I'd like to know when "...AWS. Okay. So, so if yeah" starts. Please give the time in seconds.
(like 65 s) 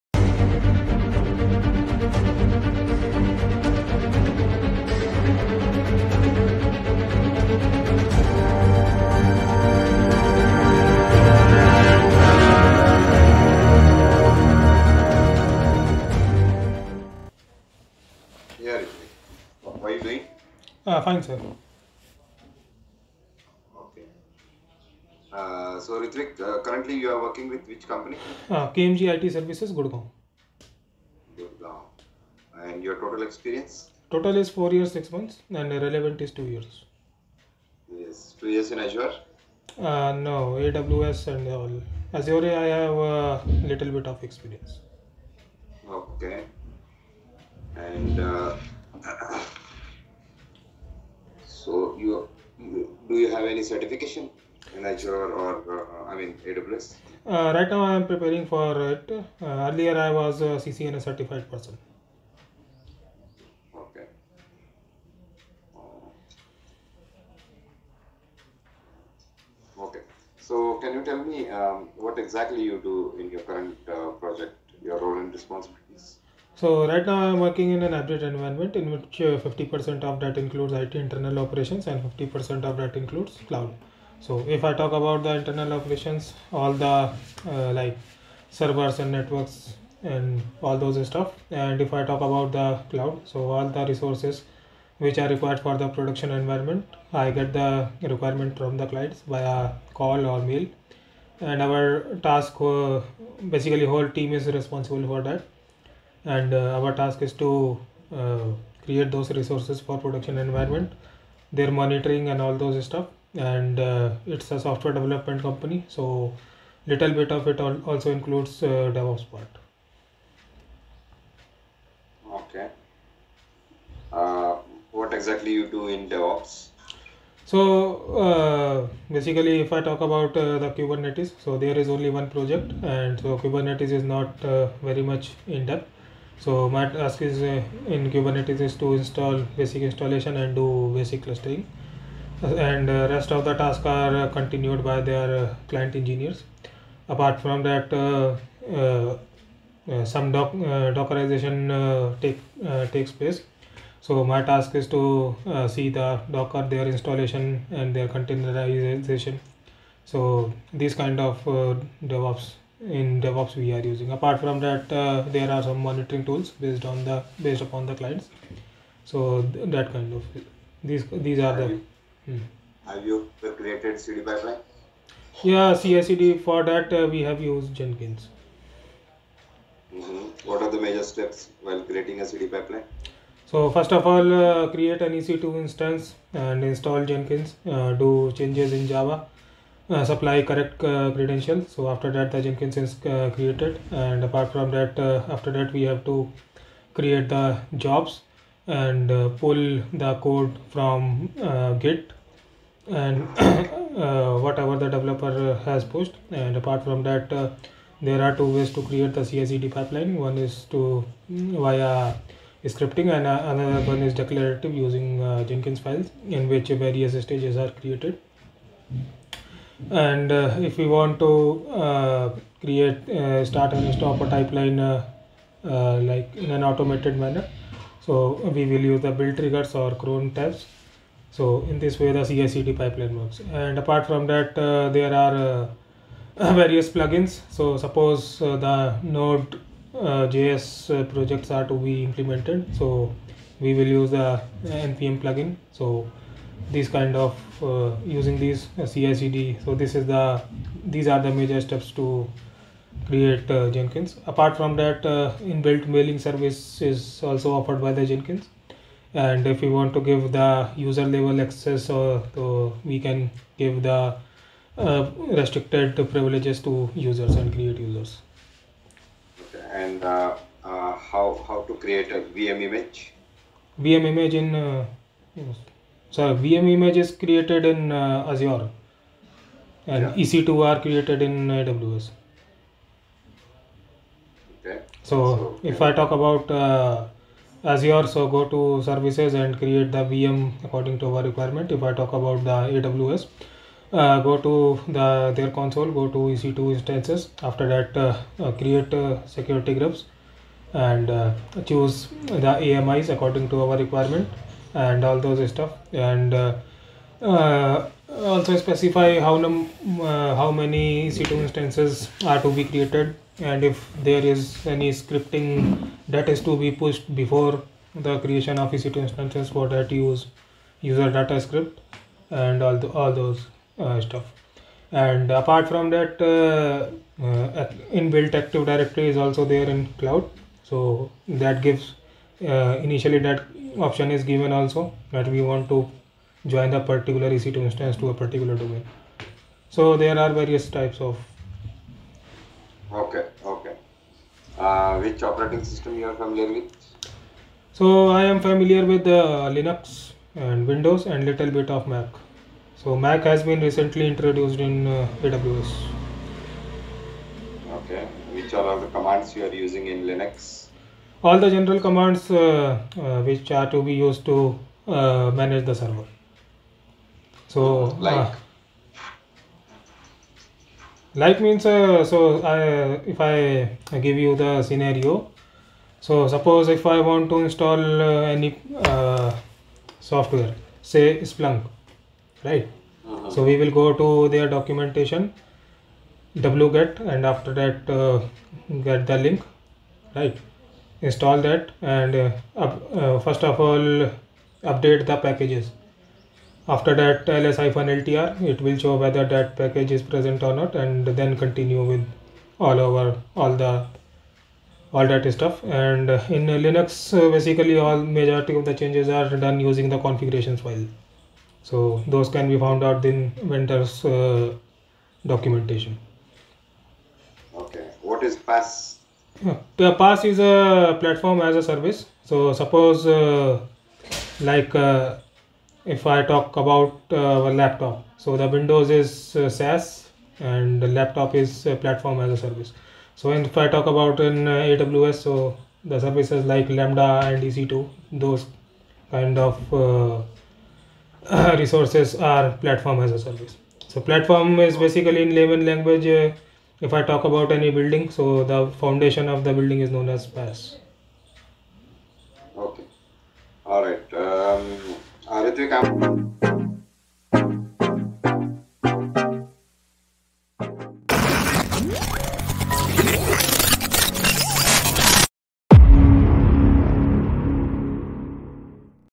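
281 s.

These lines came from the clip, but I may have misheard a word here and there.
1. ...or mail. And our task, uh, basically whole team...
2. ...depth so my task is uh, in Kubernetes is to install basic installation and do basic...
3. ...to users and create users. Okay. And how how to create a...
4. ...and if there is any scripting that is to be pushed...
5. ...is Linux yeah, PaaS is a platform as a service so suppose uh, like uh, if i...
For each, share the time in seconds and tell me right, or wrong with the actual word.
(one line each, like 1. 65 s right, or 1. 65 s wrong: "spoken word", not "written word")
1. 100 s right
2. 135 s right
3. 266 s right
4. 313 s right
5. 418 s wrong: "PaaS", not "Linux".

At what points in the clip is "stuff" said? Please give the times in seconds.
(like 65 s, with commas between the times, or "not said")
91 s, 112 s, 305 s, 324 s, 405 s.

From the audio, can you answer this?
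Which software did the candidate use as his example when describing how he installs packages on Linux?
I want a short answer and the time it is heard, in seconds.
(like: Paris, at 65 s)
Splunk, at 381 s.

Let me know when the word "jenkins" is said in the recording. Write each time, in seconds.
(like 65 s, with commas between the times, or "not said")
177 s, 187 s, 192 s, 215 s, 253 s, 258 s.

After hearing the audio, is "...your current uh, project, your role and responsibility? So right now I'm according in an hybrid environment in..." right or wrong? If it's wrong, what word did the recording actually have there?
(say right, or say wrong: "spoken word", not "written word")
wrong: "working", not "according".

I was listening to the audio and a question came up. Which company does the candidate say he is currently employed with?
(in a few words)
KMG IT Services.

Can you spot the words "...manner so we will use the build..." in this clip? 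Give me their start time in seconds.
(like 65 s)
227 s.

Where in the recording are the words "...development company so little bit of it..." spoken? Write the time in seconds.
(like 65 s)
114 s.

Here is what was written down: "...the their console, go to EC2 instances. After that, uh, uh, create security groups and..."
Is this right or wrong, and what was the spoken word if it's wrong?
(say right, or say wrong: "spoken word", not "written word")
right.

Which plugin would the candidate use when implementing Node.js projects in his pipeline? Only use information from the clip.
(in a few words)
npm plugin.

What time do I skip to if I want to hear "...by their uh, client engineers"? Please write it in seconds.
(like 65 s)
144 s.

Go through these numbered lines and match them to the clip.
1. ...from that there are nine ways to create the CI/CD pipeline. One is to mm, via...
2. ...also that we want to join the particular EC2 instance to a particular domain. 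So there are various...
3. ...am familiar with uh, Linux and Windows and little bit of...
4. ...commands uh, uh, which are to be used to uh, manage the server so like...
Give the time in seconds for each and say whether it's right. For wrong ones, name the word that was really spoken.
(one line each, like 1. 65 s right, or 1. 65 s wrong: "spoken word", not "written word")
1. 206 s wrong: "two", not "nine"
2. 334 s right
3. 348 s right
4. 361 s right.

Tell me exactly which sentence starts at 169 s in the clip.
So th that kind of these these are have the.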